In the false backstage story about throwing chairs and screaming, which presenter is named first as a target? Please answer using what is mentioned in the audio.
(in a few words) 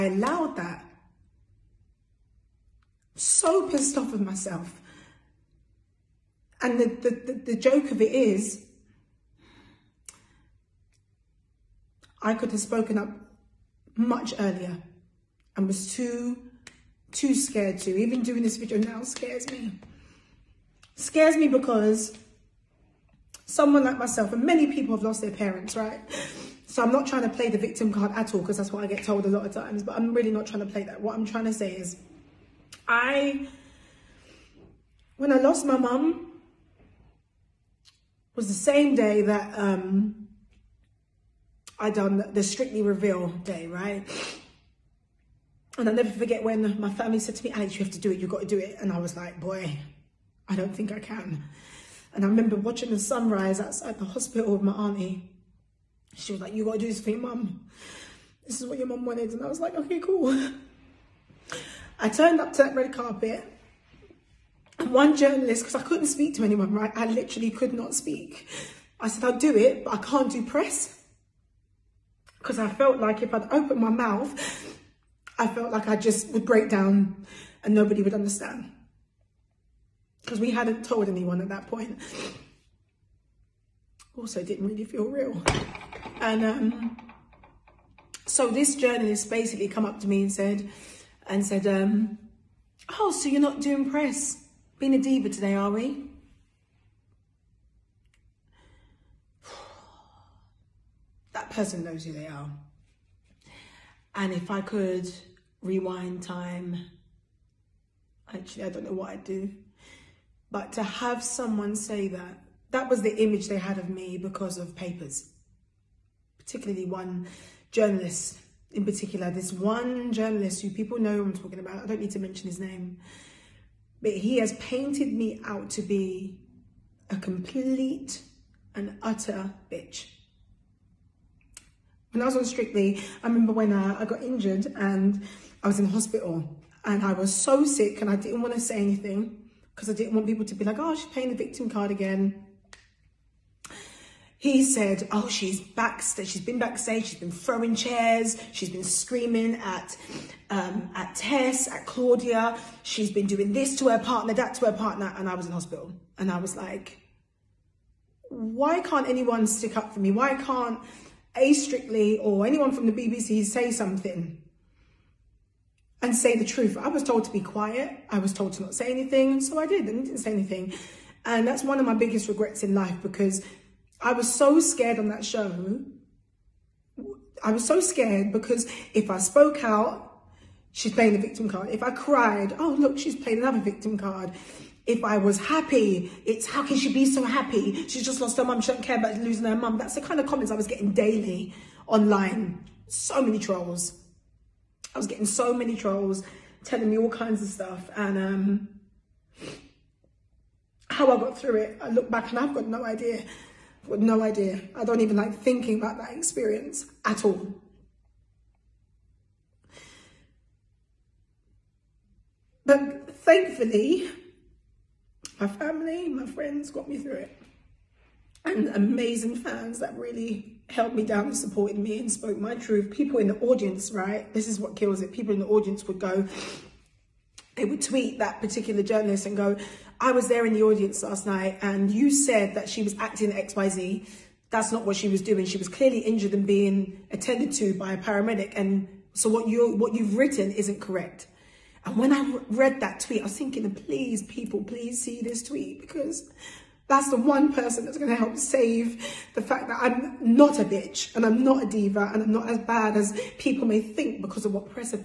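Tess.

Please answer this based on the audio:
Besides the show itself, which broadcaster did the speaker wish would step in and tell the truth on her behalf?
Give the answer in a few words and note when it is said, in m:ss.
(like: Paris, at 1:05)
BBC, at 2:42.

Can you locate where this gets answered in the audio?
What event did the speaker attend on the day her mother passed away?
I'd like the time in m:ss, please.
0:42.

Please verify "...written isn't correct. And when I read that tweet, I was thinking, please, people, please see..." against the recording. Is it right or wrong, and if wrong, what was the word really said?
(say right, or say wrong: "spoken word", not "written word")
right.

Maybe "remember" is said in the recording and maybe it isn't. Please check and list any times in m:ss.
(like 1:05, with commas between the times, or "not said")
0:52, 2:13.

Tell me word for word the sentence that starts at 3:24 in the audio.
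I don't even like thinking about that experience at all.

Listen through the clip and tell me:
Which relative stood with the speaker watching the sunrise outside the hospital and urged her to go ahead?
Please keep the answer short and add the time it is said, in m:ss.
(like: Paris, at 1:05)
Auntie, at 0:54.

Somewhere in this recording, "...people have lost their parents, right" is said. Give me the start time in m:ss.
0:24.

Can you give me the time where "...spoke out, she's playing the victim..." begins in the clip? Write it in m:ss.
2:59.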